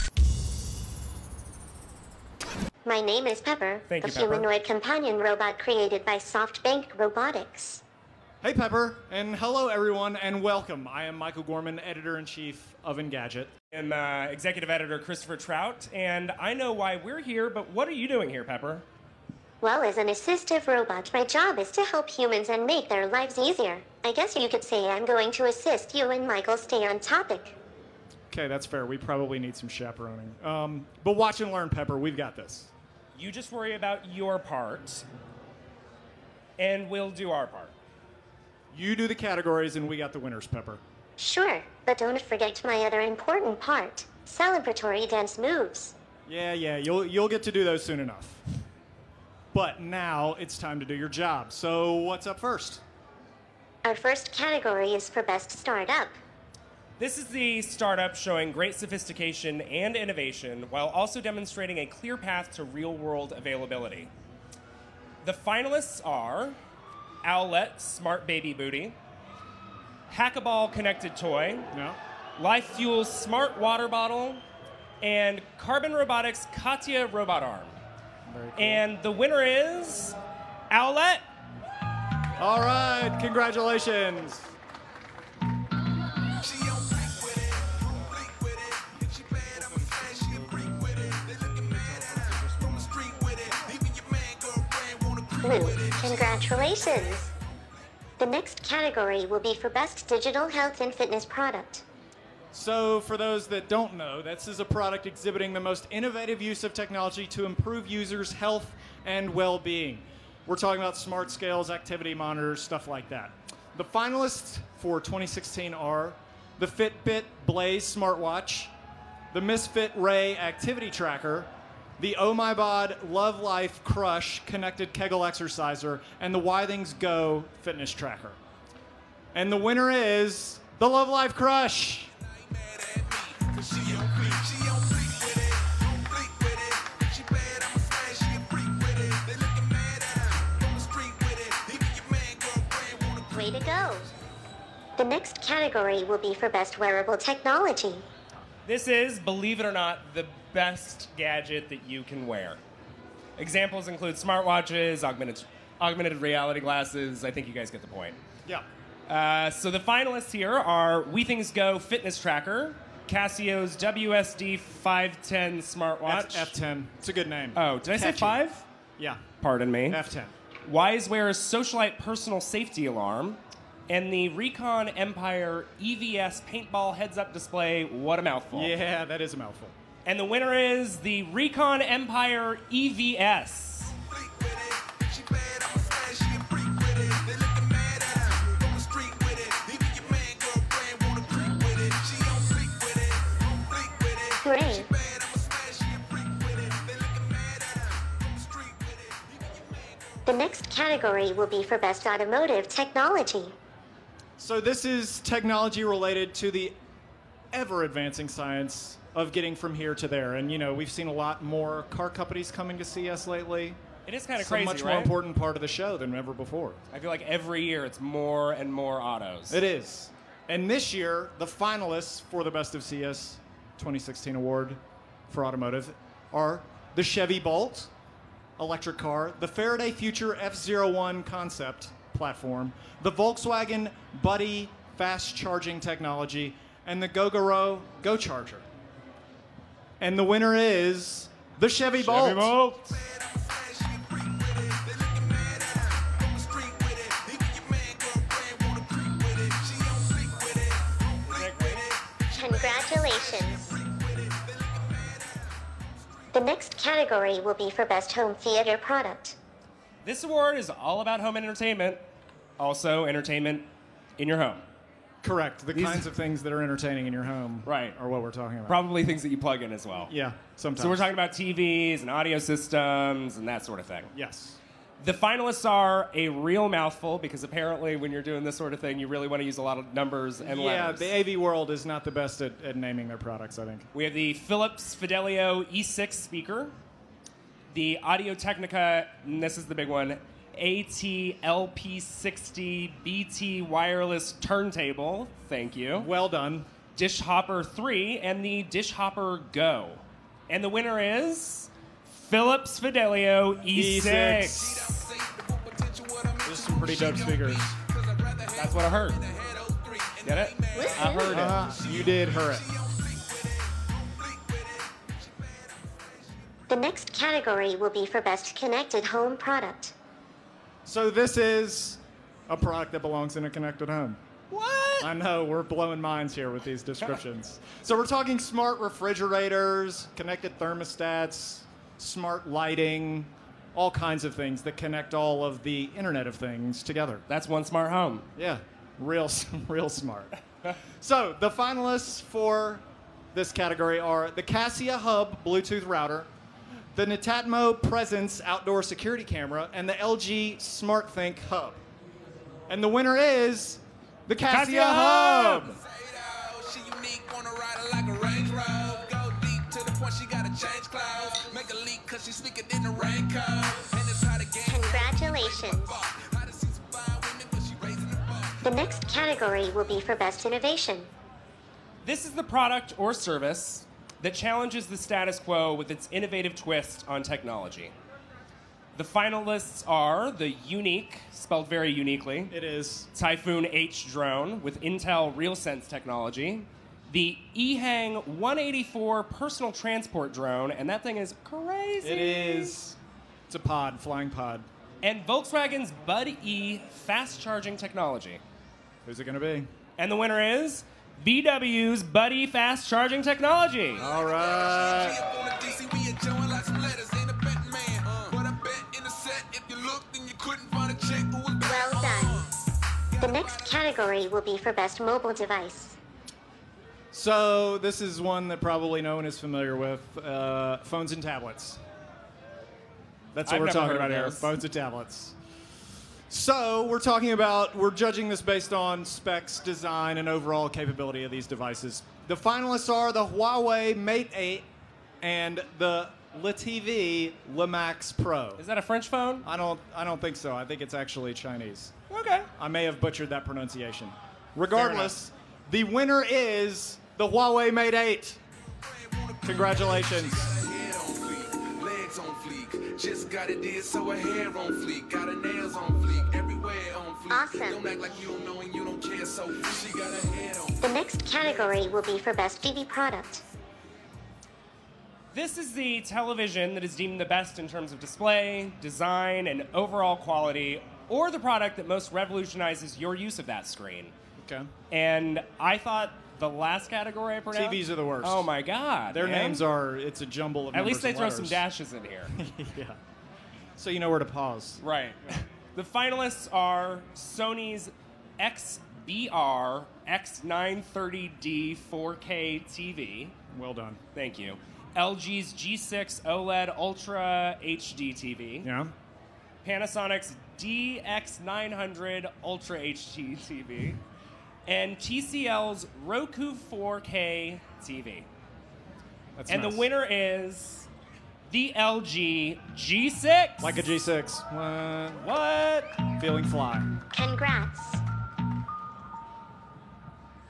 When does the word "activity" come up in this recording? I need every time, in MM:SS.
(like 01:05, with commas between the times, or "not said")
01:51, 02:00.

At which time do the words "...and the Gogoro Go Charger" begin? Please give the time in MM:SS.
03:56.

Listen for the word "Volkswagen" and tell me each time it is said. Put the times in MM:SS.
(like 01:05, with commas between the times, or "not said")
03:53, 06:35.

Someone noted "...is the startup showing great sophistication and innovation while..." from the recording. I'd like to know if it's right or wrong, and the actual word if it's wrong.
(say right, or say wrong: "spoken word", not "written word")
right.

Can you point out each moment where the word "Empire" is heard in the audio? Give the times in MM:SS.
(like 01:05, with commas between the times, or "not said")
02:54, 03:01.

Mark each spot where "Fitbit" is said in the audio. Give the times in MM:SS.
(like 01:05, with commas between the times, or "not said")
01:56.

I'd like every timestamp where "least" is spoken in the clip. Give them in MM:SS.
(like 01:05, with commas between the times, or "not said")
08:00.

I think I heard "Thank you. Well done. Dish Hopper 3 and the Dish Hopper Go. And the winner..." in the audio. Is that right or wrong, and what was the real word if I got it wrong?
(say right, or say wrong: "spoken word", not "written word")
right.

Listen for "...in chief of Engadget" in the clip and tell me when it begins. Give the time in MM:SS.
00:12.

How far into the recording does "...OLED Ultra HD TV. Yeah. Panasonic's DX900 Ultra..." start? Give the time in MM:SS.
08:16.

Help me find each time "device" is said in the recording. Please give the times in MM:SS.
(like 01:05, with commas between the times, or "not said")
06:55, 07:11.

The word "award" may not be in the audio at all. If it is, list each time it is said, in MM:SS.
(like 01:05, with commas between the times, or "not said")
03:44, 04:20.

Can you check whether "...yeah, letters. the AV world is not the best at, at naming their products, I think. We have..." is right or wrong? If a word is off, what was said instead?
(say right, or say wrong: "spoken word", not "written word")
right.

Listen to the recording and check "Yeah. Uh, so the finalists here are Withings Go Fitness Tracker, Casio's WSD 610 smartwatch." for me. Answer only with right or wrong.
wrong.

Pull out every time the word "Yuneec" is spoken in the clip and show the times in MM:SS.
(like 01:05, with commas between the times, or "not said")
06:20.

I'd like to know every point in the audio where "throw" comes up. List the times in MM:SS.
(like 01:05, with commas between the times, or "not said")
08:01.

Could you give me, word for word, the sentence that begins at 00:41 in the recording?
Sure, but don't forget my other important part celebratory dance moves.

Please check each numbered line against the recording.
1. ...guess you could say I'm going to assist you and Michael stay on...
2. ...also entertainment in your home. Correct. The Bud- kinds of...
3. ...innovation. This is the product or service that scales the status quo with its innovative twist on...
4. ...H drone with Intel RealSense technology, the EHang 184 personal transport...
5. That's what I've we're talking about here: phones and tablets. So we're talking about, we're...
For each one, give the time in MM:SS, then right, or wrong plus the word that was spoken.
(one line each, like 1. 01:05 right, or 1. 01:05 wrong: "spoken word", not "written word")
1. 00:24 right
2. 04:22 wrong: "These", not "Bud"
3. 06:10 wrong: "challenges", not "scales"
4. 06:23 right
5. 07:03 right.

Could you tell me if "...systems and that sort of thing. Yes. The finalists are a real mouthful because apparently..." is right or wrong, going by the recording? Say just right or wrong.
right.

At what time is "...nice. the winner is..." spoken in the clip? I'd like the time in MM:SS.
08:29.